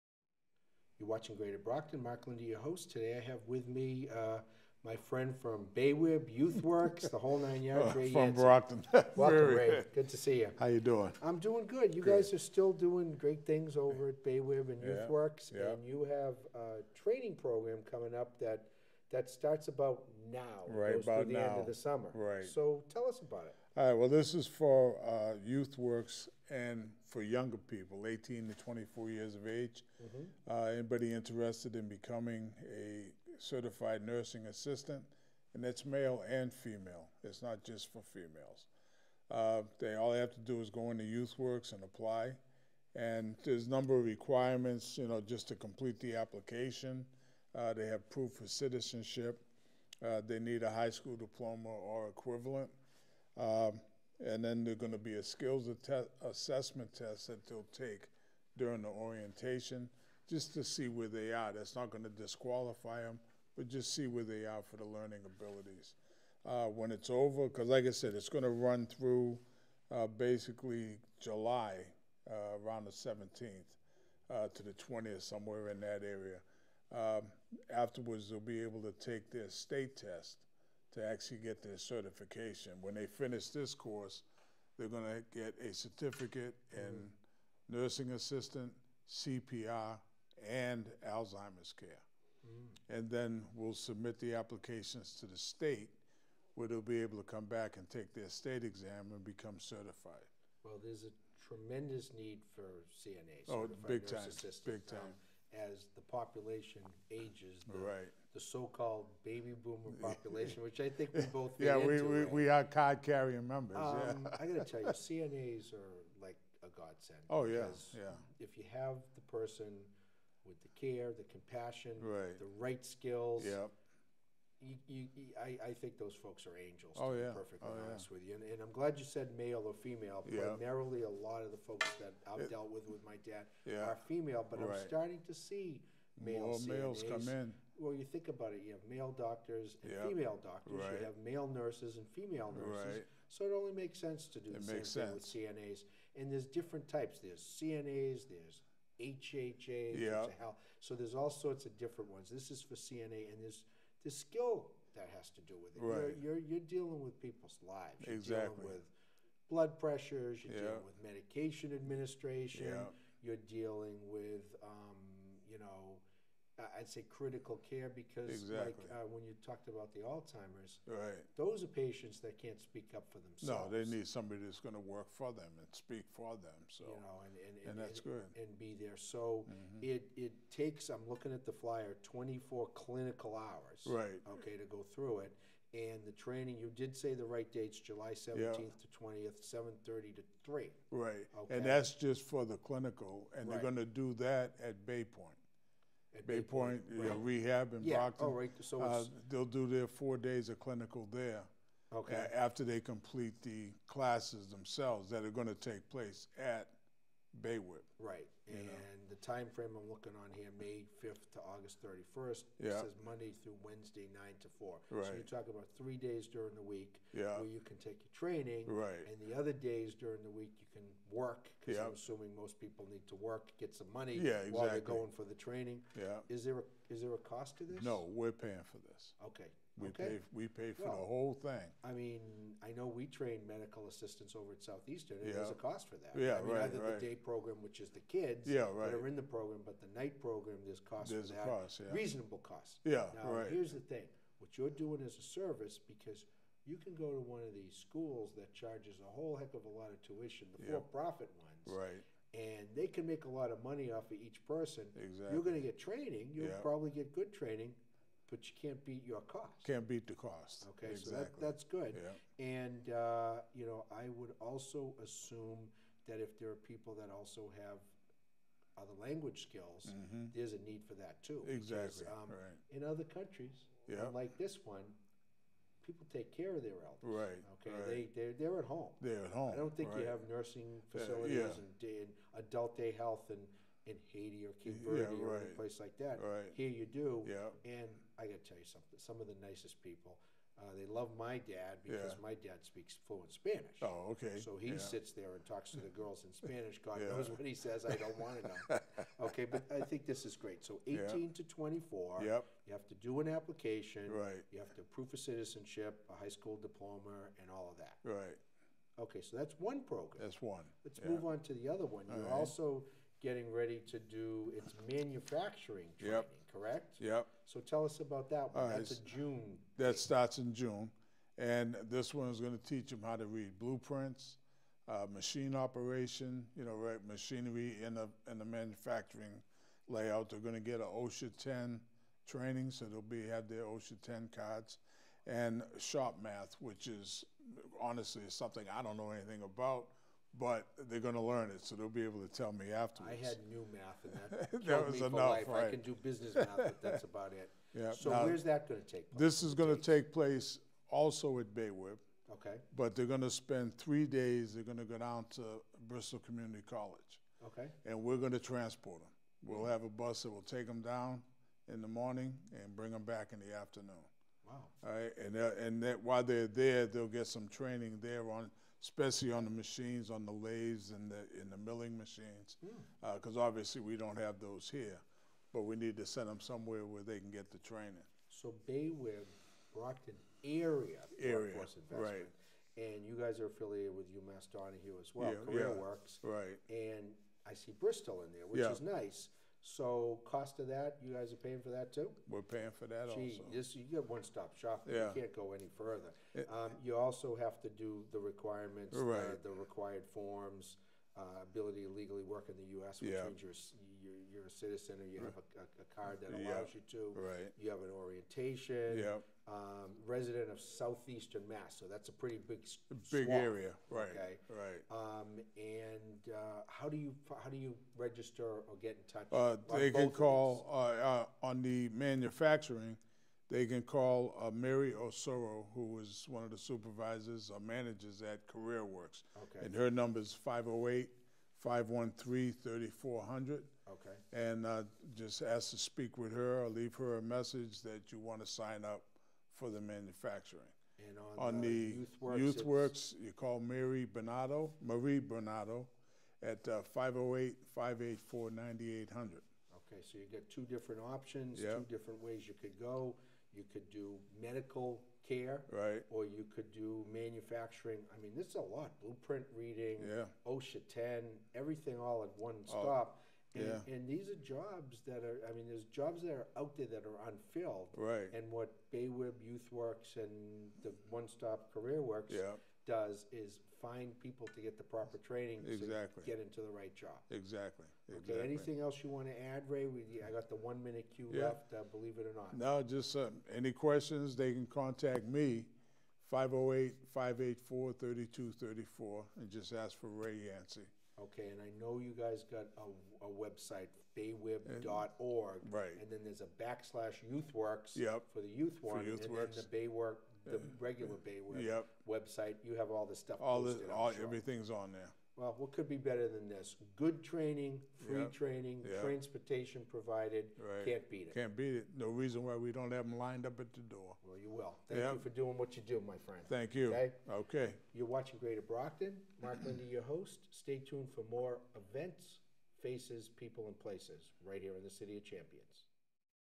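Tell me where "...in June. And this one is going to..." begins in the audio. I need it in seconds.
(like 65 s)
320 s.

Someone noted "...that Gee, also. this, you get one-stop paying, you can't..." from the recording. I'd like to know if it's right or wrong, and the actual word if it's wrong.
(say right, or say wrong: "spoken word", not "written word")
wrong: "shopping", not "paying".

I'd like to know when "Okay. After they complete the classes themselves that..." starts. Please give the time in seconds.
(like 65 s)
201 s.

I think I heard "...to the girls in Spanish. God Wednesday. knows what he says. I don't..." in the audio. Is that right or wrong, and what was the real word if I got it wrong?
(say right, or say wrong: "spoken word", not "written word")
wrong: "Yeah", not "Wednesday".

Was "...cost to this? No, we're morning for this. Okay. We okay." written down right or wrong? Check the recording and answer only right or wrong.
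wrong.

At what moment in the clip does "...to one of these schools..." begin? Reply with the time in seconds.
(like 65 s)
247 s.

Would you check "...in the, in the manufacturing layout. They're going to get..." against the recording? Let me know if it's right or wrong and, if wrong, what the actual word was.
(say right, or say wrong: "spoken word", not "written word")
right.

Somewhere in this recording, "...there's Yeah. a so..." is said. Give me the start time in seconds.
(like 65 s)
149 s.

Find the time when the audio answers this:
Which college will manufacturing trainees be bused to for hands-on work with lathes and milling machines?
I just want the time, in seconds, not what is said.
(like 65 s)
355 s.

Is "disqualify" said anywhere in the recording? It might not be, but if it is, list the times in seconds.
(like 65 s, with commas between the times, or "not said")
62 s.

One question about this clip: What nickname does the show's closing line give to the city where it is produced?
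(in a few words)
City of Champions.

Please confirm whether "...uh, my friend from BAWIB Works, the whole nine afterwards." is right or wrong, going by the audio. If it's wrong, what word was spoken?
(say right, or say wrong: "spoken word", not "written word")
wrong: "yards", not "afterwards".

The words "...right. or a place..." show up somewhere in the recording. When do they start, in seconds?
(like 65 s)
285 s.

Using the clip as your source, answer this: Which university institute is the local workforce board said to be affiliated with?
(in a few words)
UMass Donahue.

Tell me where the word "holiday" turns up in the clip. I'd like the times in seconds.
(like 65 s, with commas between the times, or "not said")
not said.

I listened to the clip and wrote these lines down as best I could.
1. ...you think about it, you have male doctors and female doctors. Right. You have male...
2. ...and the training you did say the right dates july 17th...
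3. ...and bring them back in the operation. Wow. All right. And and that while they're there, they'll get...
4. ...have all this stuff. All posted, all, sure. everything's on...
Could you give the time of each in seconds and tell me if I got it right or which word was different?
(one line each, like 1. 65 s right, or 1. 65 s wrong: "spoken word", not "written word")
1. 137 s right
2. 185 s right
3. 362 s wrong: "afternoon", not "operation"
4. 502 s right.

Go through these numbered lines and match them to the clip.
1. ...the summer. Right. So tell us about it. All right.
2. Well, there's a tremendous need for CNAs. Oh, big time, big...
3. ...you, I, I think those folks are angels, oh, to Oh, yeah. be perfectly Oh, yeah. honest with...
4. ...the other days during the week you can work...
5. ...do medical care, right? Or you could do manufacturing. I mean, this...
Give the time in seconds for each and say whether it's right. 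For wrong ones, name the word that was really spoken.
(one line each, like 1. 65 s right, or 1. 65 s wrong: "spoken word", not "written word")
1. 21 s right
2. 100 s right
3. 125 s right
4. 219 s right
5. 453 s right.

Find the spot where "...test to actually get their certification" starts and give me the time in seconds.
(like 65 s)
79 s.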